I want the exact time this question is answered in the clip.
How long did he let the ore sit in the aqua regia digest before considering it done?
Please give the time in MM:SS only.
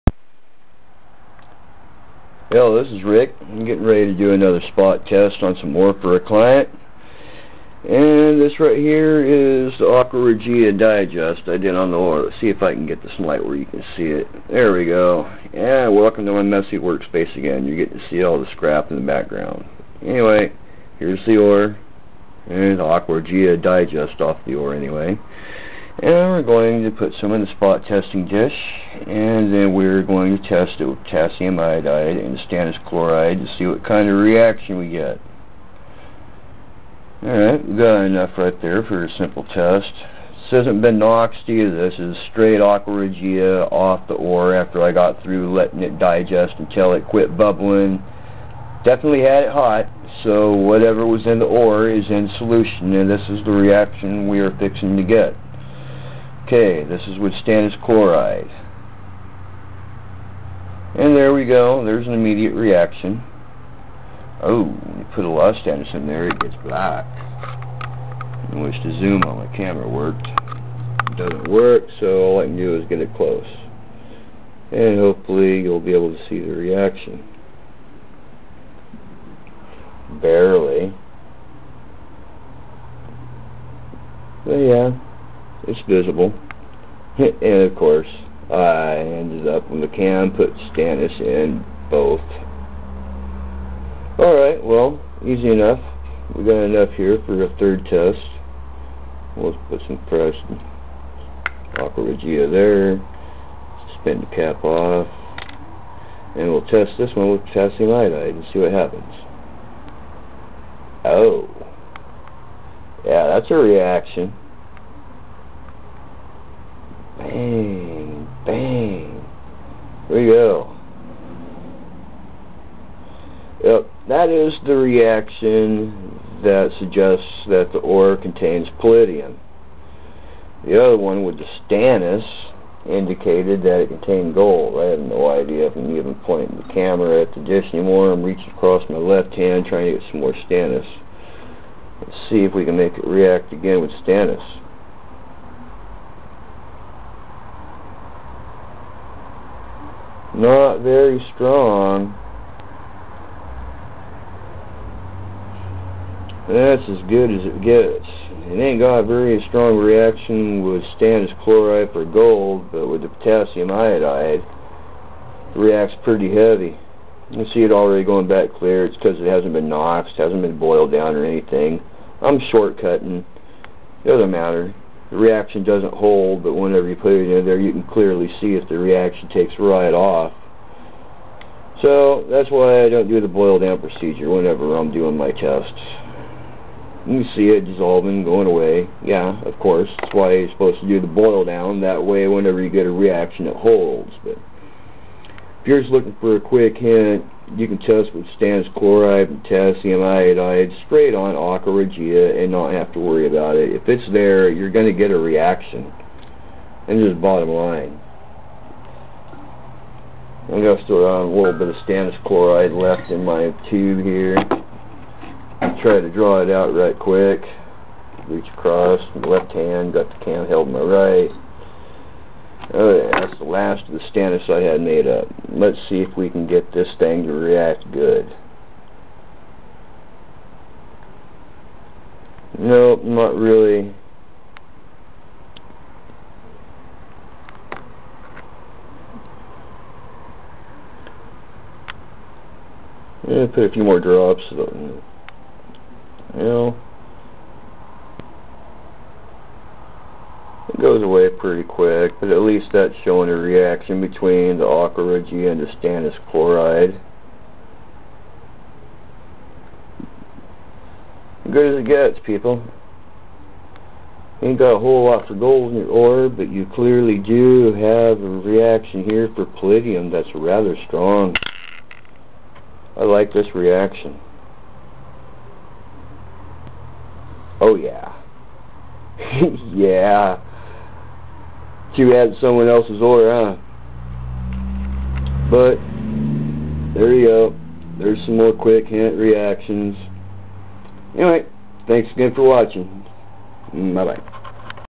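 00:46.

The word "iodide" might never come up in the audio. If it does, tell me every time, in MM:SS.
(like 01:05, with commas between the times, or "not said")
00:31, 01:47, 02:43, 03:20.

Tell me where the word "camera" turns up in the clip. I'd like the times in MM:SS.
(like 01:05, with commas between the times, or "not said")
01:09, 02:16.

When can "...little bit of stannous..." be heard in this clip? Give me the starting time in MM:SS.
03:31.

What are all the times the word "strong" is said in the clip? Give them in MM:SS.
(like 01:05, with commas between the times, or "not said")
02:31, 02:39, 04:30.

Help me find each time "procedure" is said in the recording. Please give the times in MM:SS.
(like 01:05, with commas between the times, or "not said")
03:03.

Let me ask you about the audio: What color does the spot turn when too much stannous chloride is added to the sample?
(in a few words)
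Black.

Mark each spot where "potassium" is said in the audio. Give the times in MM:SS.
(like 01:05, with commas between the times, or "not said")
00:31, 01:47, 02:43, 03:19.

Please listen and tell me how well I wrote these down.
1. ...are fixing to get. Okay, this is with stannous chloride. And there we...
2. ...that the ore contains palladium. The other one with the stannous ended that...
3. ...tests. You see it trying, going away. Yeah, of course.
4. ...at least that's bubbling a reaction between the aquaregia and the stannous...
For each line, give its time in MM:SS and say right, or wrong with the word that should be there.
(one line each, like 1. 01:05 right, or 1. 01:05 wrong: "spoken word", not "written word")
1. 00:54 right
2. 02:07 wrong: "indicated", not "ended"
3. 03:05 wrong: "dissolving", not "trying"
4. 04:12 wrong: "showing", not "bubbling".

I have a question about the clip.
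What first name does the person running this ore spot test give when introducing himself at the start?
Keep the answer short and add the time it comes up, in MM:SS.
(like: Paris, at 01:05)
Rick, at 00:03.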